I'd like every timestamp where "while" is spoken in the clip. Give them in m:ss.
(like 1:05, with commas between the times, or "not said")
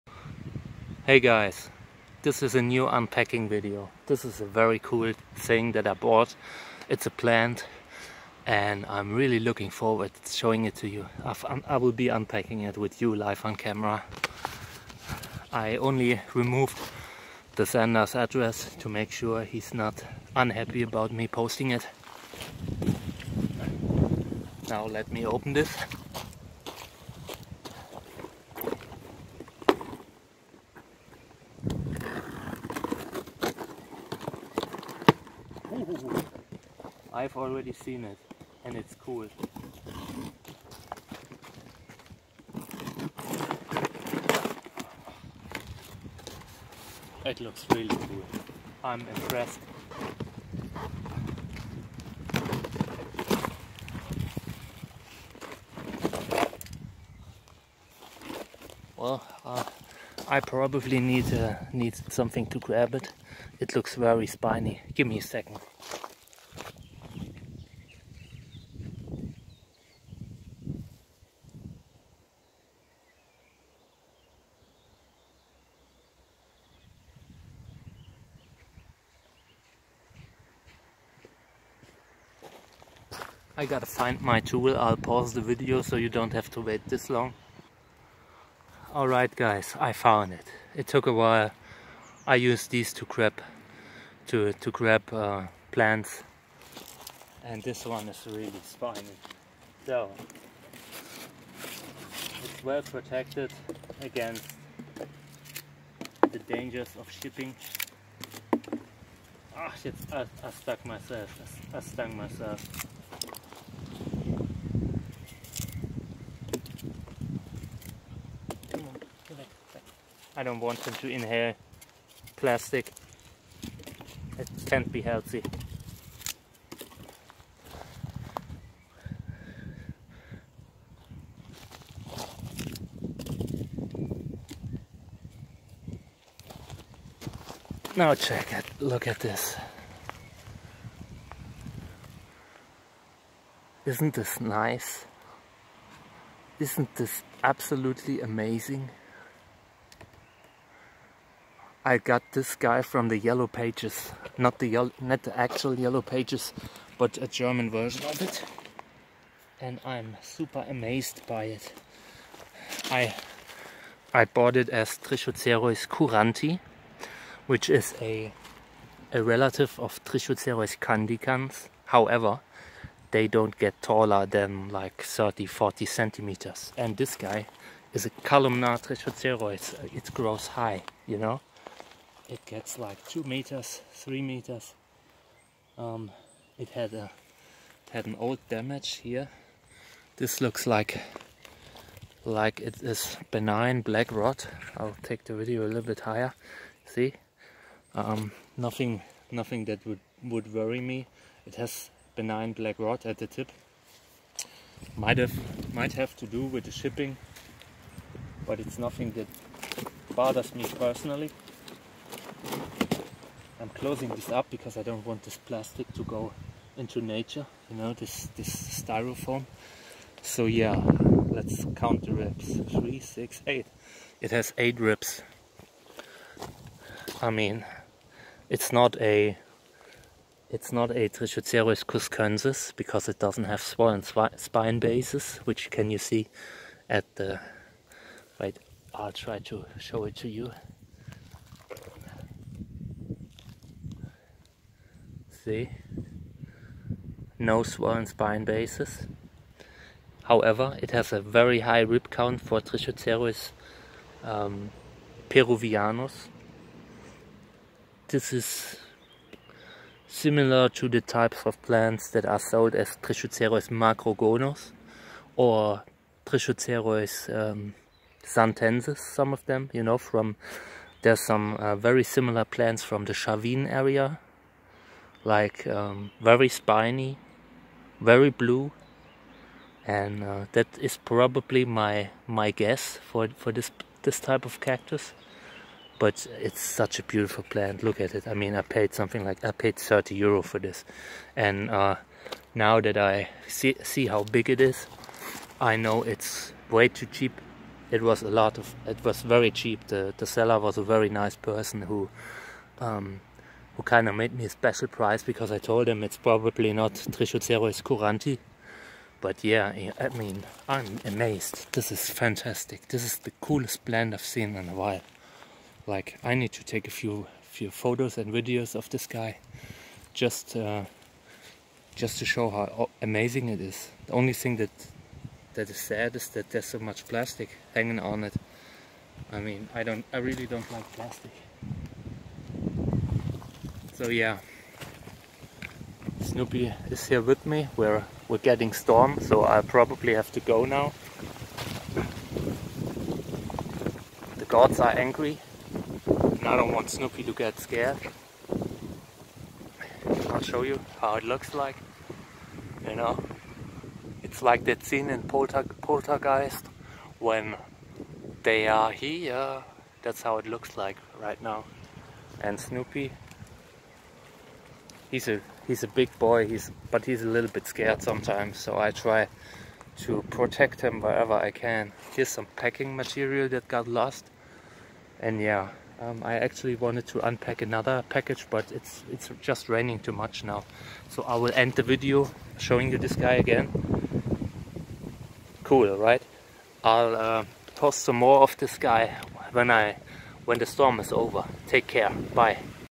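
1:31, 5:14.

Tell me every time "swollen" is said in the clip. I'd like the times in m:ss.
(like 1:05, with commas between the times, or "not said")
3:53, 4:07.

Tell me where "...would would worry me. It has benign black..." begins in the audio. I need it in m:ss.
3:19.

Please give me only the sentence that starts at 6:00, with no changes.
That's how it looks like right now.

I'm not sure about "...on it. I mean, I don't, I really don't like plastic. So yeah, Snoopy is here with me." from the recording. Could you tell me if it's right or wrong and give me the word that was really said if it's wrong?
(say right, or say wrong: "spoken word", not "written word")
right.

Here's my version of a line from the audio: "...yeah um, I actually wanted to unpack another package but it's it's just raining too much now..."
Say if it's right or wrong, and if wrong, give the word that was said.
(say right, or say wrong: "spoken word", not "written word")
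right.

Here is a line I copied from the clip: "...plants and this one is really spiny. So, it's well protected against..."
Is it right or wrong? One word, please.
right.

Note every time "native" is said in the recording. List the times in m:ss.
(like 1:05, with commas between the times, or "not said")
not said.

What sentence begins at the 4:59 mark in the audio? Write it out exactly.
The the seller was a very nice person who.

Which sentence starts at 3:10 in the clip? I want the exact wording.
This looks like like it is benign black rot.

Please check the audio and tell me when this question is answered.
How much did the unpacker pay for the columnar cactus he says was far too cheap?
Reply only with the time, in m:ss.
4:49.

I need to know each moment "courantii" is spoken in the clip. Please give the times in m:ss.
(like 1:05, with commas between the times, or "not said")
2:45, 5:07.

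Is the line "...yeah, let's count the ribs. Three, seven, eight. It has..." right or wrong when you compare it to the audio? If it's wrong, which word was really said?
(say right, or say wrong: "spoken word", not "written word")
wrong: "six", not "seven".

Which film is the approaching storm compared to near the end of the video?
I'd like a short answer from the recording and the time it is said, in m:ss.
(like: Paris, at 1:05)
Poltergeist, at 5:55.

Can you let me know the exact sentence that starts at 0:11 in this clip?
I've, I will be unpacking it with you live on camera.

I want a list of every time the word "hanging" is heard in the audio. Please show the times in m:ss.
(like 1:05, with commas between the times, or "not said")
5:27.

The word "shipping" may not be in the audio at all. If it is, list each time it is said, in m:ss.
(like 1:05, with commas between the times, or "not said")
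1:47, 3:26.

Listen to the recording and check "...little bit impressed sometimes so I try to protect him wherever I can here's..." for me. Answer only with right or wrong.
wrong.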